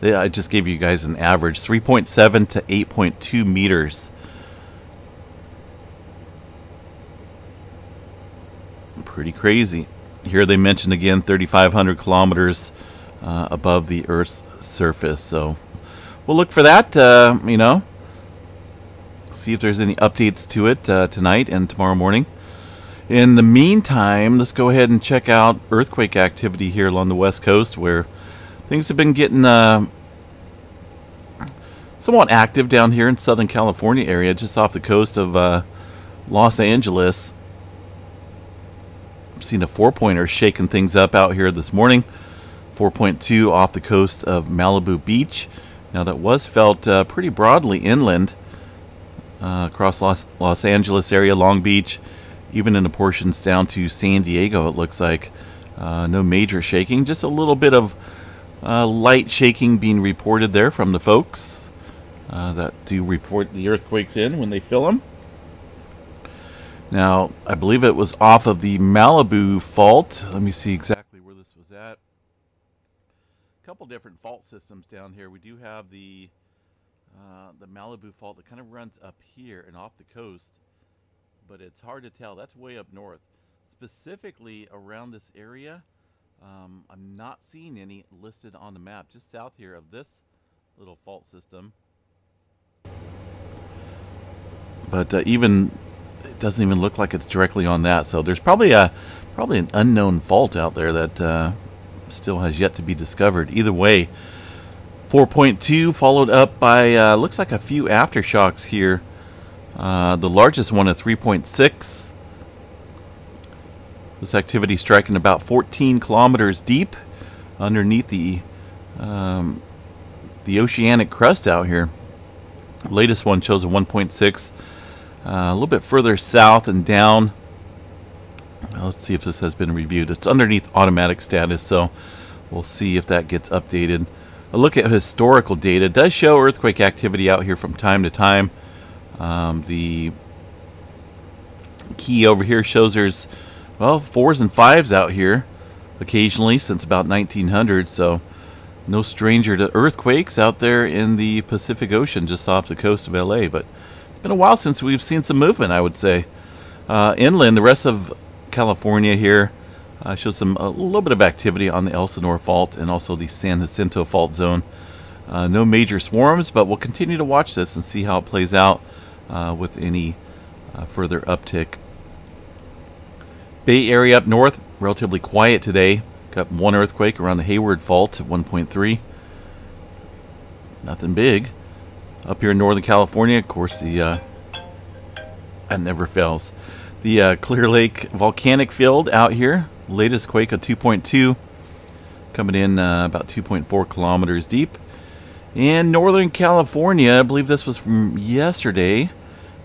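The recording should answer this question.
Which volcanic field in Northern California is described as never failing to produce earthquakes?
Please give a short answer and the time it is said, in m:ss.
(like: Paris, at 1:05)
Clear Lake volcanic field, at 3:07.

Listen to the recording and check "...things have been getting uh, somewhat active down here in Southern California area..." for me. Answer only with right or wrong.
right.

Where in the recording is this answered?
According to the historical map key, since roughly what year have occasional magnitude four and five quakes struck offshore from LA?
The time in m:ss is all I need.
2:27.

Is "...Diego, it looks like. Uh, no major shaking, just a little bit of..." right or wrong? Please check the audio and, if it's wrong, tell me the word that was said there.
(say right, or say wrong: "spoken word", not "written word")
right.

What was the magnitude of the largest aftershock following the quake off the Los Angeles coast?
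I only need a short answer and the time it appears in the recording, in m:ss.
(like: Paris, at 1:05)
3.6, at 1:50.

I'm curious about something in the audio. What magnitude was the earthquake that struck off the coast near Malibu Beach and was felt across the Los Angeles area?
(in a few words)
4.2.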